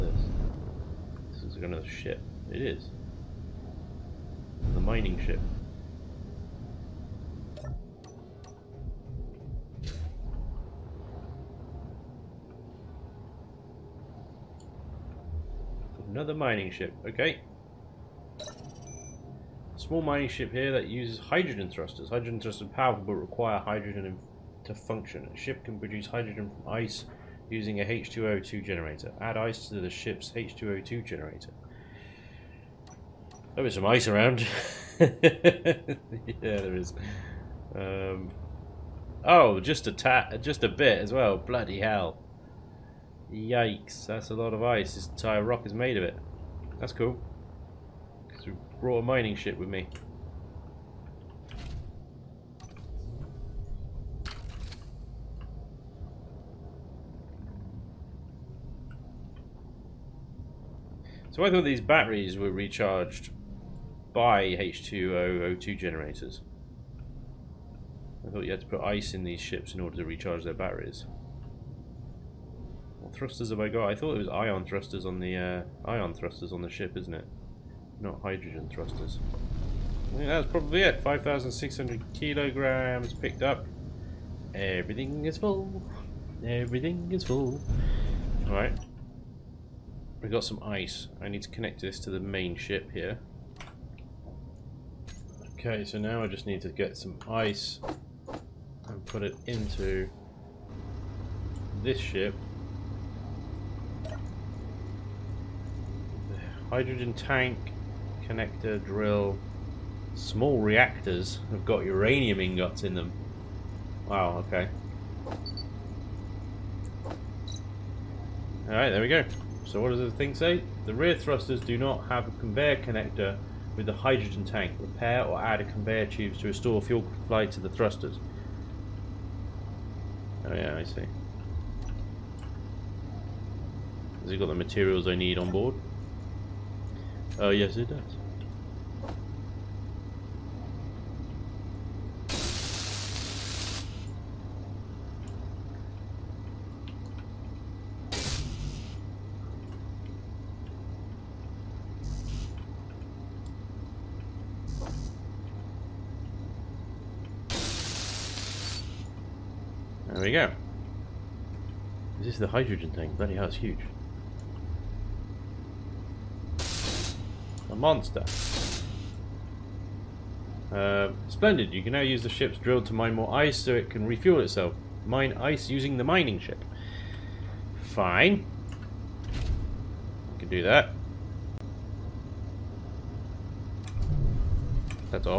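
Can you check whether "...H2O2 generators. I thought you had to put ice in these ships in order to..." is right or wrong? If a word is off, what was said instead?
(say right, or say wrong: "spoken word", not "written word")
right.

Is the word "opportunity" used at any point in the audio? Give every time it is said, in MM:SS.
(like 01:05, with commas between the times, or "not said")
not said.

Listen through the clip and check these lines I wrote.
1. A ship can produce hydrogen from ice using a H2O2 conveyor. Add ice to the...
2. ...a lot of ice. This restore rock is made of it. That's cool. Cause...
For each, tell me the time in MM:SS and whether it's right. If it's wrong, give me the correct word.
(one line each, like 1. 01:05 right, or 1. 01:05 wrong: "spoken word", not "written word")
1. 00:25 wrong: "generator", not "conveyor"
2. 00:44 wrong: "entire", not "restore".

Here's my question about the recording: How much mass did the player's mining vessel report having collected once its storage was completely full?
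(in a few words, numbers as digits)
5,600 kilograms.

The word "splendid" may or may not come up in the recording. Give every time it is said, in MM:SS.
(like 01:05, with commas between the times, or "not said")
02:51.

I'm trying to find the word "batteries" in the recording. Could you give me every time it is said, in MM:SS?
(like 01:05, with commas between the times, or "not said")
01:01, 01:10.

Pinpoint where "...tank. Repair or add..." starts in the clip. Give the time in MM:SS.
02:04.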